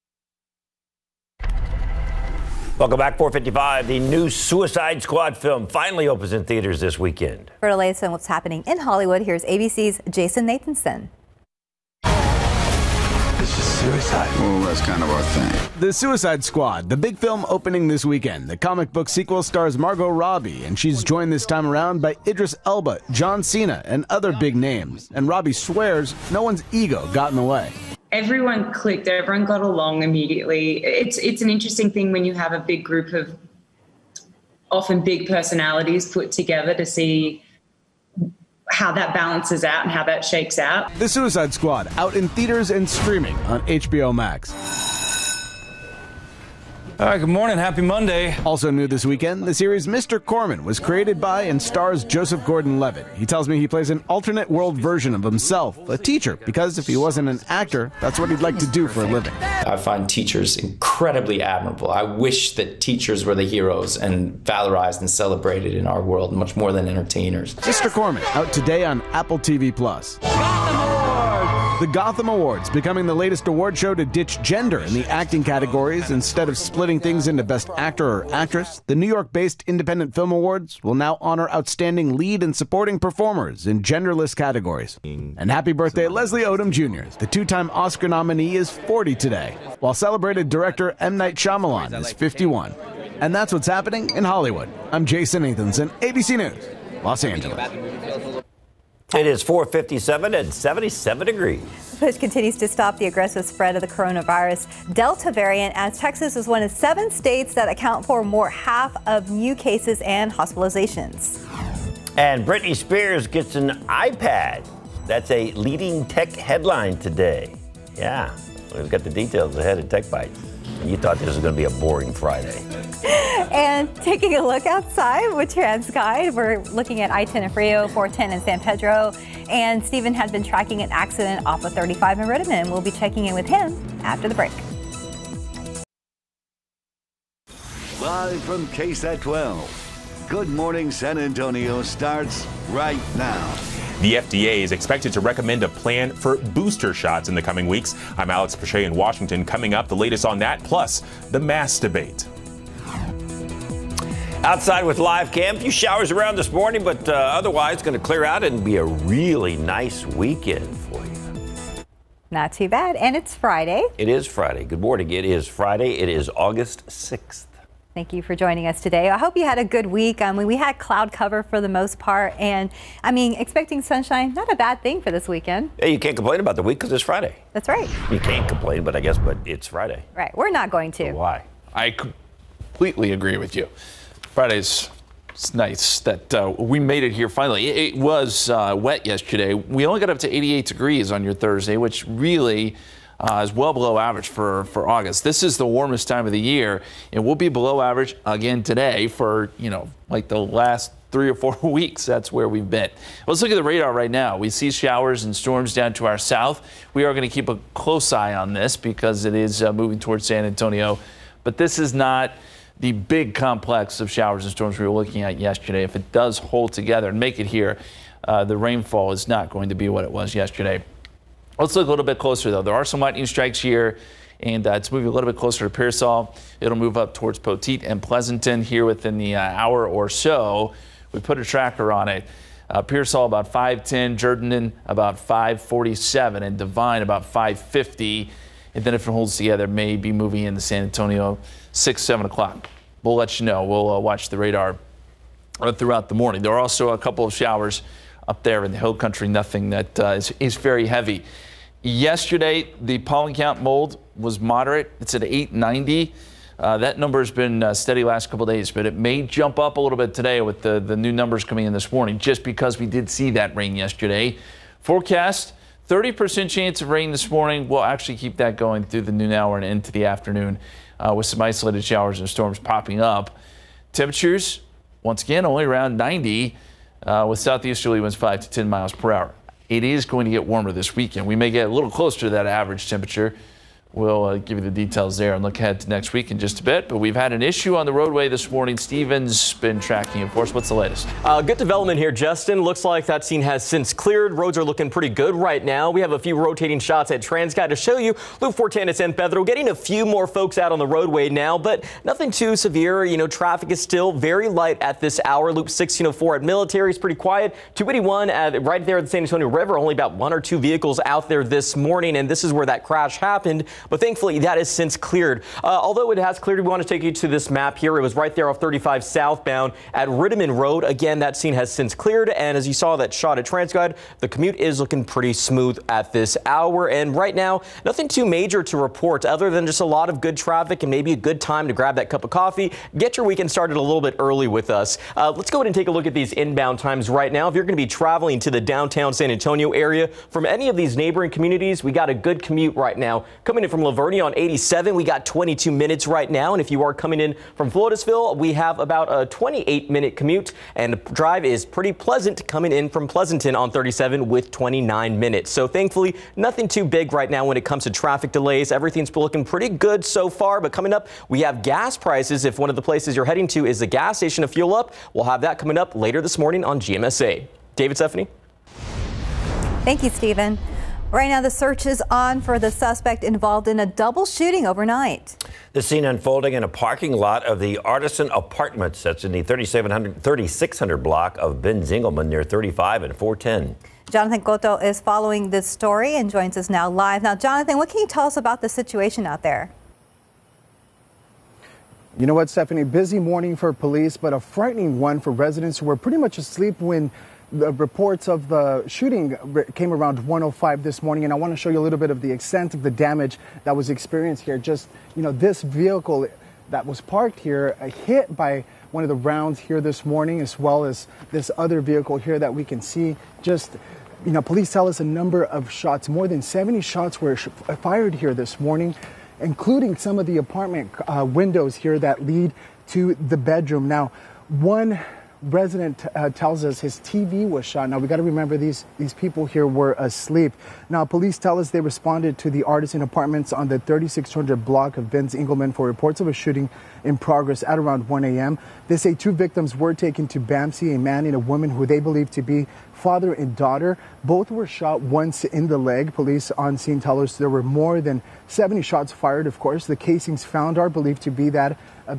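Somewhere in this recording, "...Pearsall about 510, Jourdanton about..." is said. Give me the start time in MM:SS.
03:52.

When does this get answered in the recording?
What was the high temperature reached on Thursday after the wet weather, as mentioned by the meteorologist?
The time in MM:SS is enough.
03:10.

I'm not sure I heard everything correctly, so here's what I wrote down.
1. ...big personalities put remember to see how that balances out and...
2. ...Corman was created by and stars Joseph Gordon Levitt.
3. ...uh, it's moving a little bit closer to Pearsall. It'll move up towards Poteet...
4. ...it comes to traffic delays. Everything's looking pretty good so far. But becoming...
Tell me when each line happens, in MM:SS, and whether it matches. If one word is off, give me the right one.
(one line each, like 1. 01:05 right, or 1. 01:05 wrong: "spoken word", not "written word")
1. 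00:35 wrong: "together", not "remember"
2. 00:50 right
3. 03:44 right
4. 05:57 wrong: "coming", not "becoming".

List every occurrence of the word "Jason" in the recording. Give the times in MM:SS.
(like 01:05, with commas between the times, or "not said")
00:10, 01:35.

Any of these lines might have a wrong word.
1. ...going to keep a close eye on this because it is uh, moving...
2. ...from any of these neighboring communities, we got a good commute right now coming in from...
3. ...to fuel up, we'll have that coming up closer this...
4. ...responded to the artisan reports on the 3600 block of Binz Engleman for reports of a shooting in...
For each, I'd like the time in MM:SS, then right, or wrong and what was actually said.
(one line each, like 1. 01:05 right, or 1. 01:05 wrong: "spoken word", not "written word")
1. 03:27 right
2. 05:40 right
3. 06:04 wrong: "later", not "closer"
4. 07:11 wrong: "apartments", not "reports".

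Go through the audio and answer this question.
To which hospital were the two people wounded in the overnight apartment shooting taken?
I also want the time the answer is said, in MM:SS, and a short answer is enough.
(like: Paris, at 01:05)
BAMC, at 07:20.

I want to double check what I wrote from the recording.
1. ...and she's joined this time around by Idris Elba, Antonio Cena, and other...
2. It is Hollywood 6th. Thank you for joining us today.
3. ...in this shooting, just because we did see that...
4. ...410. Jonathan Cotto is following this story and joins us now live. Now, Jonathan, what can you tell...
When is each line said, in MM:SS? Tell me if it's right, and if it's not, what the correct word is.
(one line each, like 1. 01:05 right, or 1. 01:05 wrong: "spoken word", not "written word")
1. 00:20 wrong: "John", not "Antonio"
2. 02:45 wrong: "August", not "Hollywood"
3. 04:21 wrong: "morning", not "shooting"
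4. 06:23 right.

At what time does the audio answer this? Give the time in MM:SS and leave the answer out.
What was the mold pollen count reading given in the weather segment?
04:15.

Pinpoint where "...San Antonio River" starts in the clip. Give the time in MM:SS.
05:09.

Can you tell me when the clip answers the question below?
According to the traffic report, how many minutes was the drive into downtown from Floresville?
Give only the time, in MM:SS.
05:49.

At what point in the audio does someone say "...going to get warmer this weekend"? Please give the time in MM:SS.
04:40.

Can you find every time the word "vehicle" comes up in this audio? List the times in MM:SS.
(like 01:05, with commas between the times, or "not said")
05:10, 06:45, 06:51.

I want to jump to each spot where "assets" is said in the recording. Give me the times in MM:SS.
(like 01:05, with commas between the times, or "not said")
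not said.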